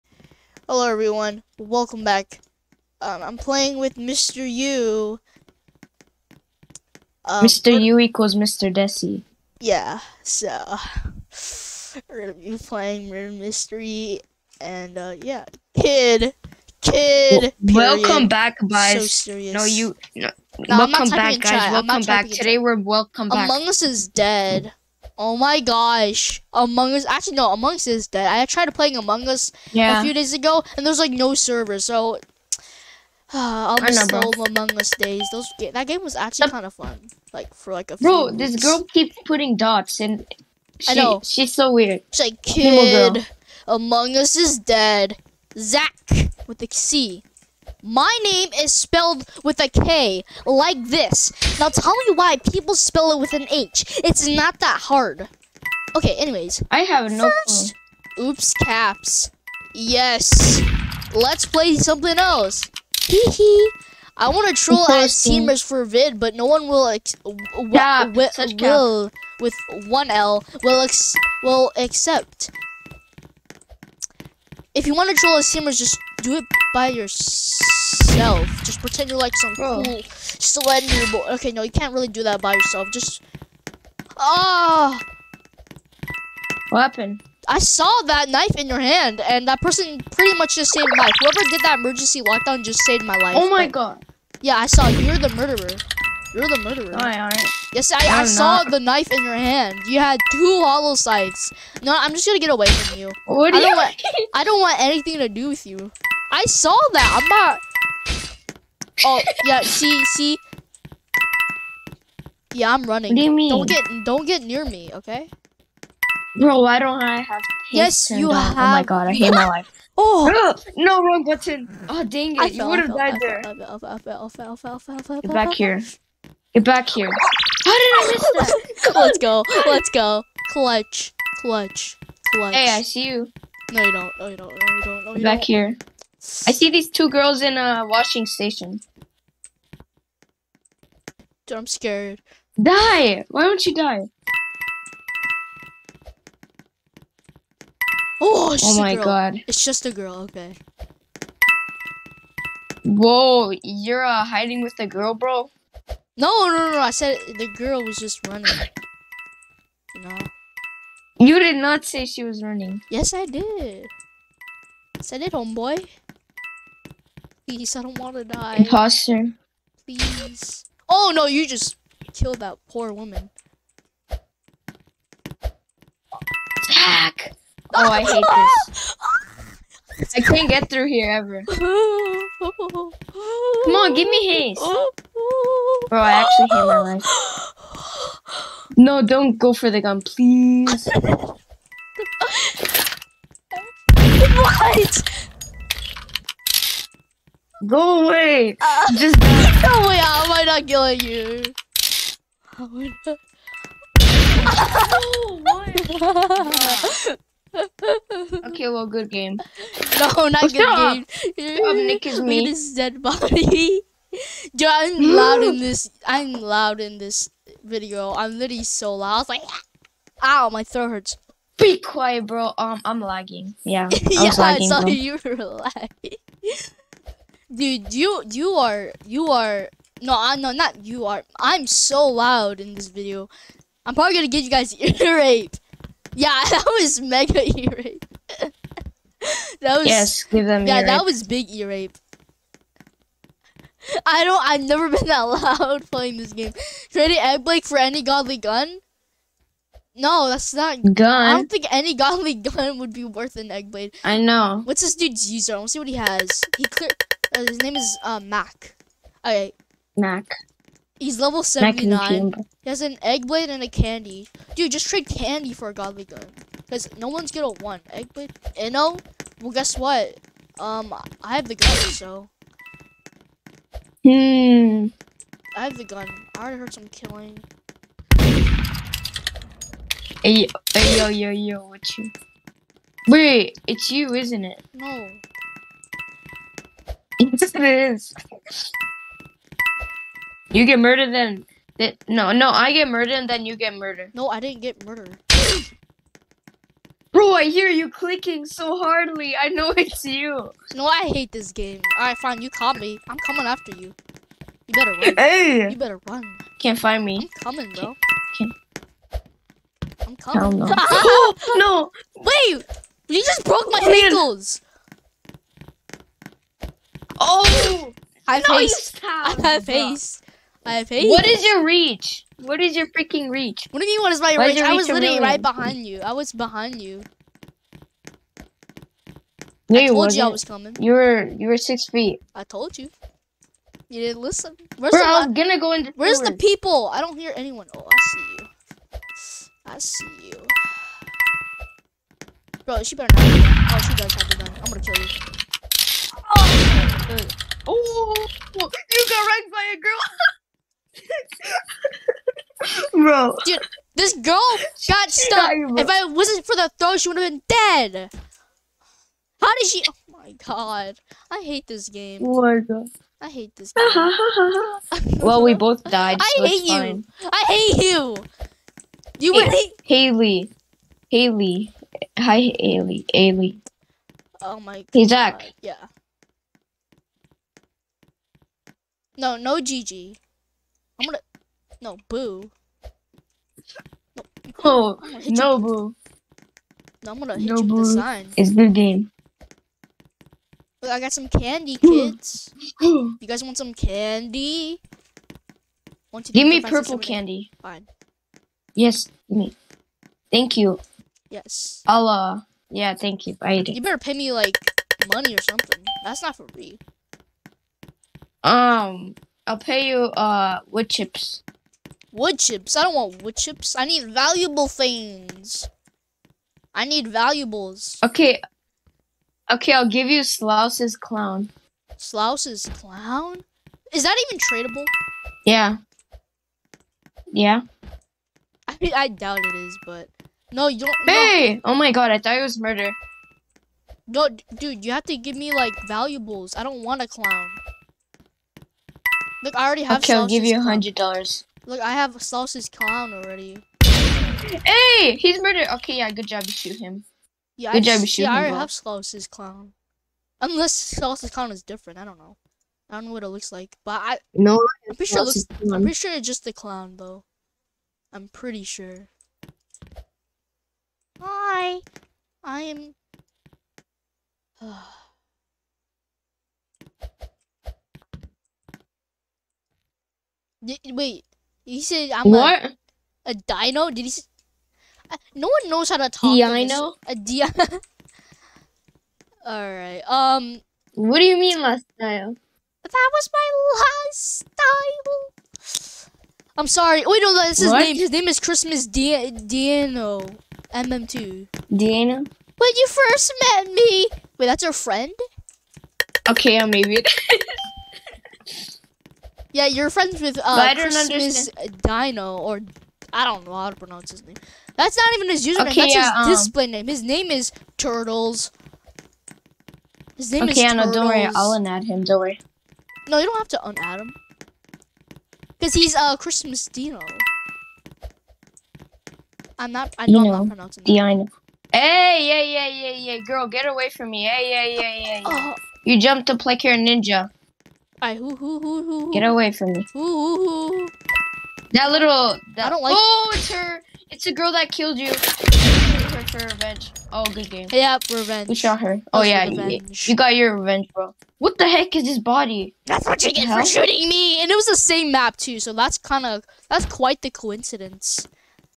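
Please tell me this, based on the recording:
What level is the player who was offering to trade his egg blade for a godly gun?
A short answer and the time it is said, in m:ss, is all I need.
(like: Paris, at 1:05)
79, at 4:21.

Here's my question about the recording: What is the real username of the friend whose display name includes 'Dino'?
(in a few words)
Turtles.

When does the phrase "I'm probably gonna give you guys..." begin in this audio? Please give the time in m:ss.
3:53.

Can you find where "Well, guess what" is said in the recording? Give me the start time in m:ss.
4:29.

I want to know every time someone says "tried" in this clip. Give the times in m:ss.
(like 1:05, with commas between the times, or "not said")
0:28.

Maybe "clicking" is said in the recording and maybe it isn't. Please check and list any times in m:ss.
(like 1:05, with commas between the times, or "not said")
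4:57.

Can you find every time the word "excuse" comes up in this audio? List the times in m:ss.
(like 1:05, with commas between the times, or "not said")
not said.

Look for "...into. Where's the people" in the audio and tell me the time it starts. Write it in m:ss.
5:35.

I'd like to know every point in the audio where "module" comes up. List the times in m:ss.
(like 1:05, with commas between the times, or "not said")
not said.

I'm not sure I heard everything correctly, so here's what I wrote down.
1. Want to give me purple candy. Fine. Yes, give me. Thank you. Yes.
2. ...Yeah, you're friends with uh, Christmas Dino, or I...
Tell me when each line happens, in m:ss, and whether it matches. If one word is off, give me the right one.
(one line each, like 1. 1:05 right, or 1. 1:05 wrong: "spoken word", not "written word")
1. 6:36 right
2. 8:19 right.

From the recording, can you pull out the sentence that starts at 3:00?
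I can't get through here ever.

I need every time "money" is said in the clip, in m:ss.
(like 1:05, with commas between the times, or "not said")
6:45.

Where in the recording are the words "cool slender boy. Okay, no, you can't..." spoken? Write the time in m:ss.
1:19.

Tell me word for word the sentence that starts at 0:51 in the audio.
Now tell me why people spell it with an H.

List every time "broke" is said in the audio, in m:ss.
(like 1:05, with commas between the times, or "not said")
5:13.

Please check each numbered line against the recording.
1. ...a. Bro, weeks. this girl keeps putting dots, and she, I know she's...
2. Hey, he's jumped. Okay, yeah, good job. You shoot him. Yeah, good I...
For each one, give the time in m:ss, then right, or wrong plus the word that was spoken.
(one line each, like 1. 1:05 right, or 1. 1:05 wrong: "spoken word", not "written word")
1. 0:37 right
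2. 7:24 wrong: "murdered", not "jumped".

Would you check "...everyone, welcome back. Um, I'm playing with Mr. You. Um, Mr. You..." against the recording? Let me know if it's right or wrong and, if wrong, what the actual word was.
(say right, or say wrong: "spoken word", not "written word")
right.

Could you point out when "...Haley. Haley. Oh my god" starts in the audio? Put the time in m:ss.
6:12.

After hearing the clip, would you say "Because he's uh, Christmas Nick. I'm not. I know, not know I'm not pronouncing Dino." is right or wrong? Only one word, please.
wrong.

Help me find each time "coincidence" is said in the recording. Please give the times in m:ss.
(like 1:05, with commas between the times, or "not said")
9:07.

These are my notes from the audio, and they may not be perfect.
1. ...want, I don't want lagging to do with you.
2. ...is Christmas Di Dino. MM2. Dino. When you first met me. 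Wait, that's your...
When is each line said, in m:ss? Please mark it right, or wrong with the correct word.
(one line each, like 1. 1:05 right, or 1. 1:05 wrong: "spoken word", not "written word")
1. 1:43 wrong: "anything", not "lagging"
2. 8:08 right.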